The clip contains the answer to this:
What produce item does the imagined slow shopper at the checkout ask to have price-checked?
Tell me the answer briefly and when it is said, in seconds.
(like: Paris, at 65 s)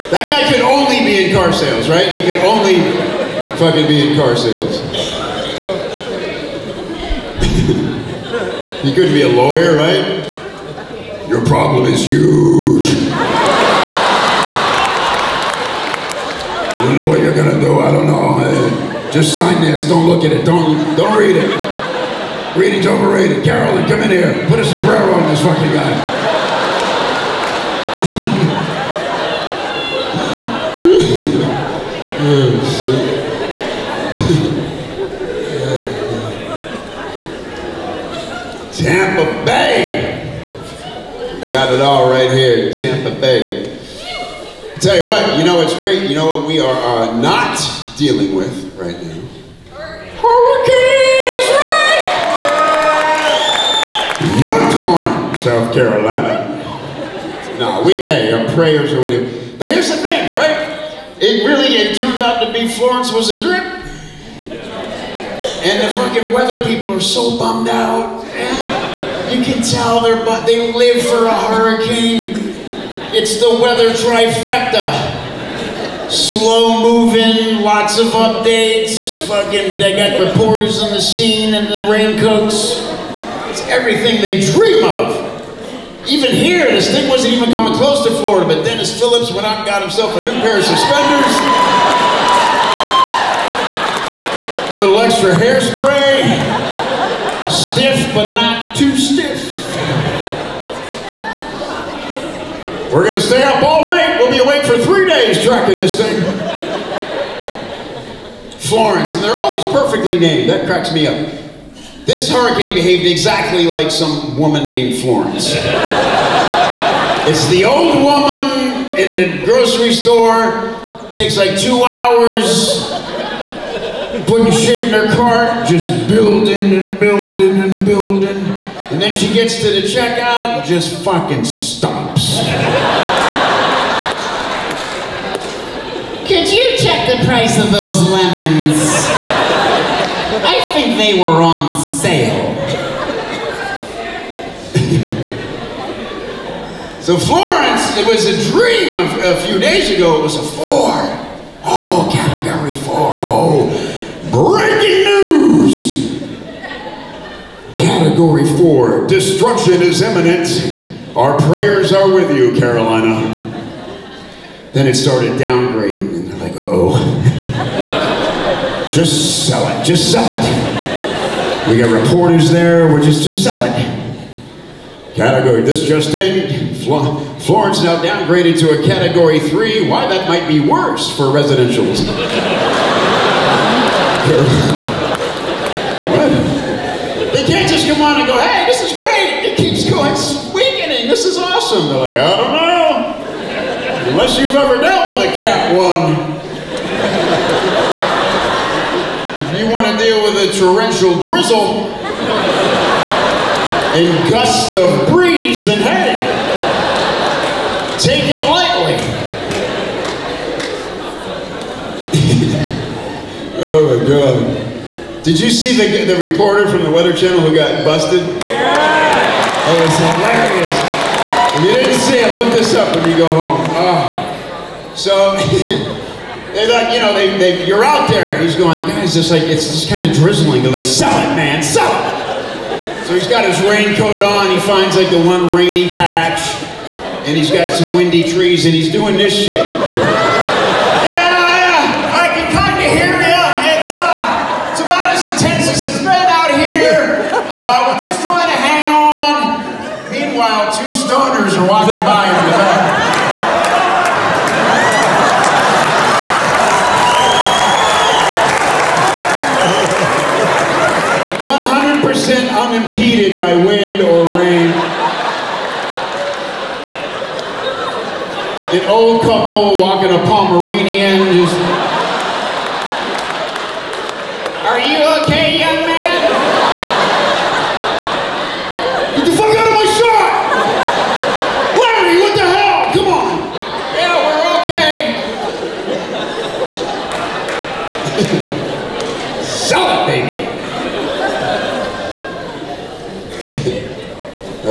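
lemons, at 138 s.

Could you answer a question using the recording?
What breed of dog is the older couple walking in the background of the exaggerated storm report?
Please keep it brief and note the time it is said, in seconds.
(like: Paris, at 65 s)
Pomeranian, at 270 s.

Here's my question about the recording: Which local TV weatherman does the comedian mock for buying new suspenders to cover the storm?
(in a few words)
Denis Phillips.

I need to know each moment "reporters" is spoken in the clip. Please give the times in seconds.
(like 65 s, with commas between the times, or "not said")
80 s, 171 s, 216 s.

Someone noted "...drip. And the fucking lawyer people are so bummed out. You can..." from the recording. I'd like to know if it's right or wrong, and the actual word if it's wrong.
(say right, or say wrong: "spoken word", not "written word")
wrong: "weather", not "lawyer".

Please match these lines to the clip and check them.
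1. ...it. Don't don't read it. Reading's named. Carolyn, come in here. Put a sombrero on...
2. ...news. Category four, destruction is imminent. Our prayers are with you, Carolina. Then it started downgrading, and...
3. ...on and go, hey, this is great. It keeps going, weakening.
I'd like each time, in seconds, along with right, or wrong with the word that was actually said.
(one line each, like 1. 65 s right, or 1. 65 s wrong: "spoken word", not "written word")
1. 20 s wrong: "overrated", not "named"
2. 155 s right
3. 188 s right.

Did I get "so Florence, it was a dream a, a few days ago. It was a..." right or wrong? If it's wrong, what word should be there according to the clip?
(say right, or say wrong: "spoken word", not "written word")
right.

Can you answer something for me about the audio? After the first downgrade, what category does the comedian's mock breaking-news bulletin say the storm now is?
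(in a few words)
category 3.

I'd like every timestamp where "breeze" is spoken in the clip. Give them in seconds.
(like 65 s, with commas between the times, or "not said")
205 s.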